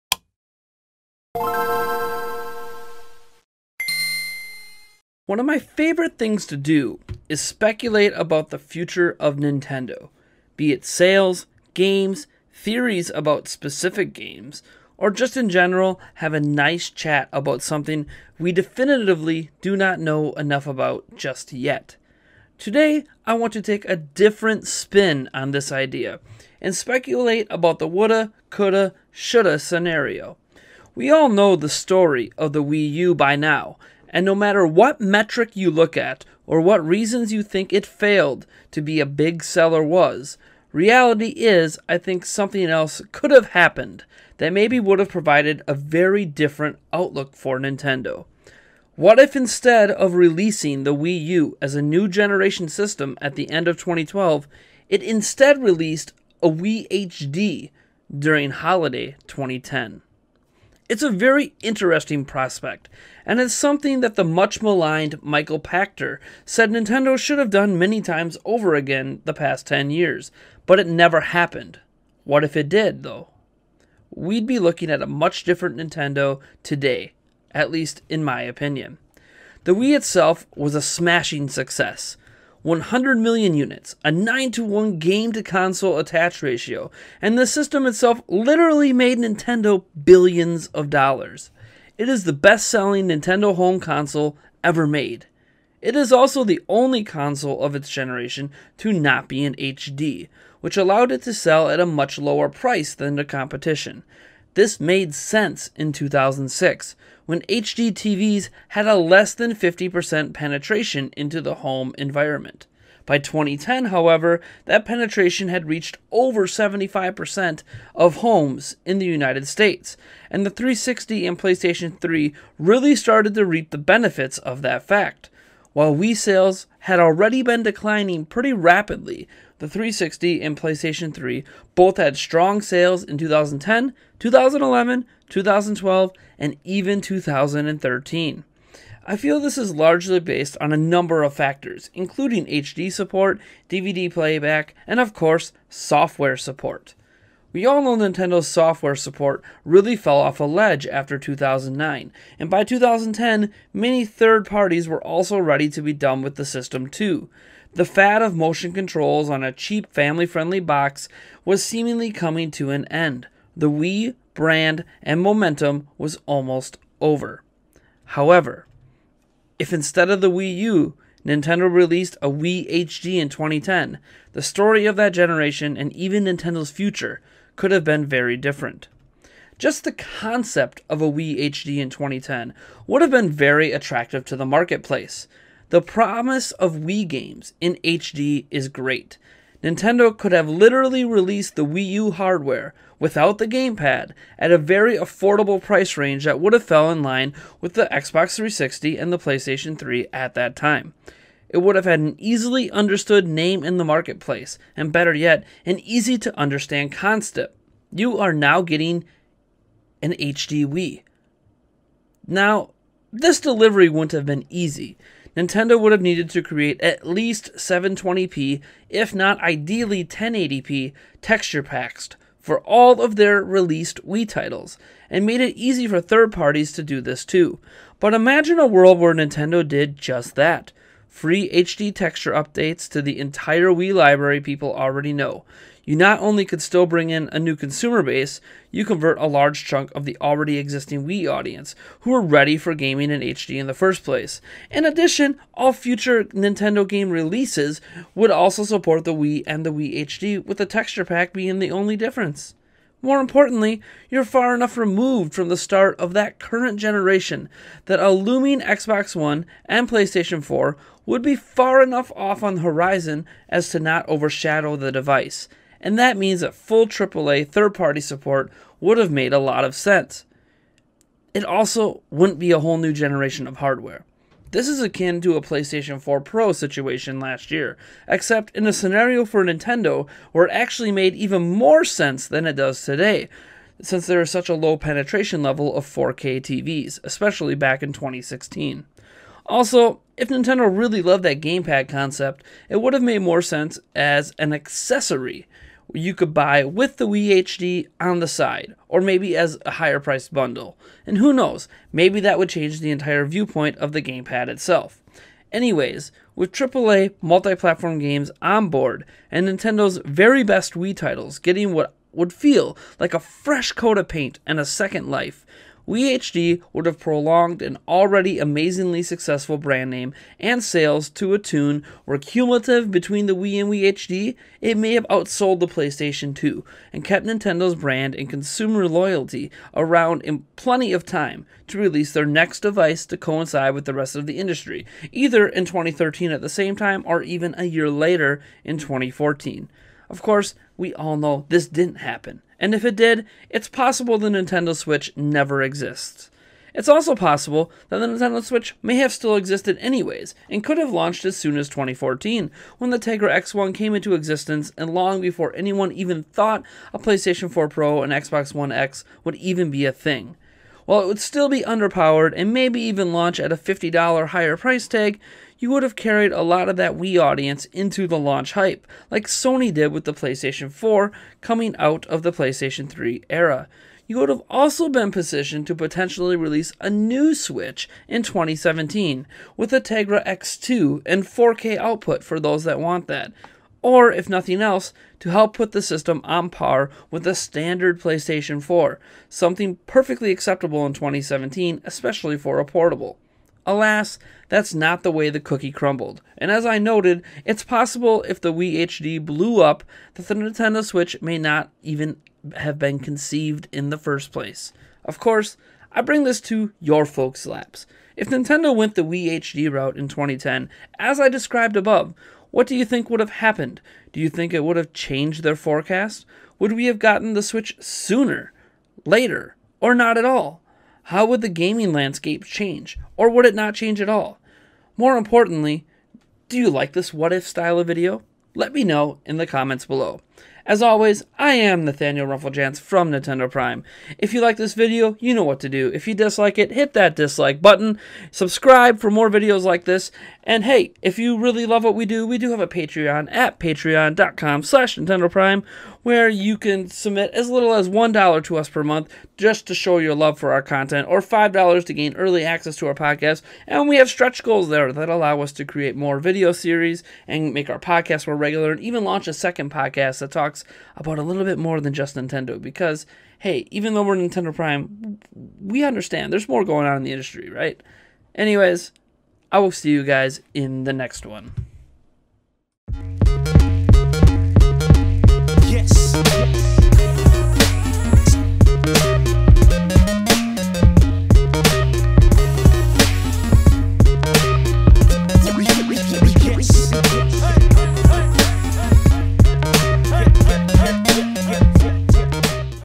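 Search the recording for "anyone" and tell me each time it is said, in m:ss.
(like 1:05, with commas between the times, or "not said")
5:55.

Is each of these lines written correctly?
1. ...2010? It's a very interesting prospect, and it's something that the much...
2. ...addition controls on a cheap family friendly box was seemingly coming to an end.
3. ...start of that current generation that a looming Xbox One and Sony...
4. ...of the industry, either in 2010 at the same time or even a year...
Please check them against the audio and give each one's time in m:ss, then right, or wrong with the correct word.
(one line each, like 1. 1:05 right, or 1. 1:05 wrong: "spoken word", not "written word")
1. 0:59 right
2. 2:38 wrong: "motion", not "addition"
3. 4:15 wrong: "PlayStation", not "Sony"
4. 5:34 wrong: "2013", not "2010".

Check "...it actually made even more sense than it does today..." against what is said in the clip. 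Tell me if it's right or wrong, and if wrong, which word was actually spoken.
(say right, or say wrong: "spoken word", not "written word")
right.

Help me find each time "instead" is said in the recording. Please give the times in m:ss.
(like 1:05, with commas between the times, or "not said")
0:49, 0:55, 2:49.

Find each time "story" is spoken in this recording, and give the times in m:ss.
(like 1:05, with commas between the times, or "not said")
0:31, 2:54.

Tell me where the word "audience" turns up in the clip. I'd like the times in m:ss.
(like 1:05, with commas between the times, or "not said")
4:01, 6:07.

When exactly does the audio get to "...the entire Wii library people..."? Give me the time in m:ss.
3:53.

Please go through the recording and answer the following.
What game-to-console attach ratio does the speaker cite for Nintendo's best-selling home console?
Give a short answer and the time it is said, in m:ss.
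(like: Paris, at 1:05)
9 to 1, at 1:24.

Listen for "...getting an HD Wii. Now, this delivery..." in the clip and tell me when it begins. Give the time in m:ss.
3:28.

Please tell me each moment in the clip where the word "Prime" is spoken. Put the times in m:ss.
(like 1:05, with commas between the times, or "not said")
7:13, 7:25, 7:44.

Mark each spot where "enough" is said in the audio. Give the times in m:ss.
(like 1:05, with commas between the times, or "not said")
0:20, 4:14, 4:21.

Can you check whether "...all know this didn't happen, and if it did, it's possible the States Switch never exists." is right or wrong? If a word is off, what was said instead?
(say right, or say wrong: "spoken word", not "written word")
wrong: "Nintendo", not "States".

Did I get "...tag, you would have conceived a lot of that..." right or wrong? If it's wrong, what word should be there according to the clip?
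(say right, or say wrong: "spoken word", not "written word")
wrong: "carried", not "conceived".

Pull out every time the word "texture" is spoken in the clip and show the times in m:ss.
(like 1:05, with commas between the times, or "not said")
3:41, 3:51, 4:10.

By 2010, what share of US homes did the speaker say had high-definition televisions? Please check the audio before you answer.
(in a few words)
over 75%.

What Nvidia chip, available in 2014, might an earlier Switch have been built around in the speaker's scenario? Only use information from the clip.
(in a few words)
Tegra X1.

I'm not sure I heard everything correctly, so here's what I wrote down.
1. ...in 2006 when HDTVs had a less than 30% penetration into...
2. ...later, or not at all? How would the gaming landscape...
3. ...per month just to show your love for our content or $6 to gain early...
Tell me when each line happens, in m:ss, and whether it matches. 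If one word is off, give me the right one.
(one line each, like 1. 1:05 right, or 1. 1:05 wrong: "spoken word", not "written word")
1. 1:45 wrong: "50", not "30"
2. 6:59 right
3. 7:28 wrong: "5", not "6".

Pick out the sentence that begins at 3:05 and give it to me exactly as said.
The promise of Wii games in HD is great.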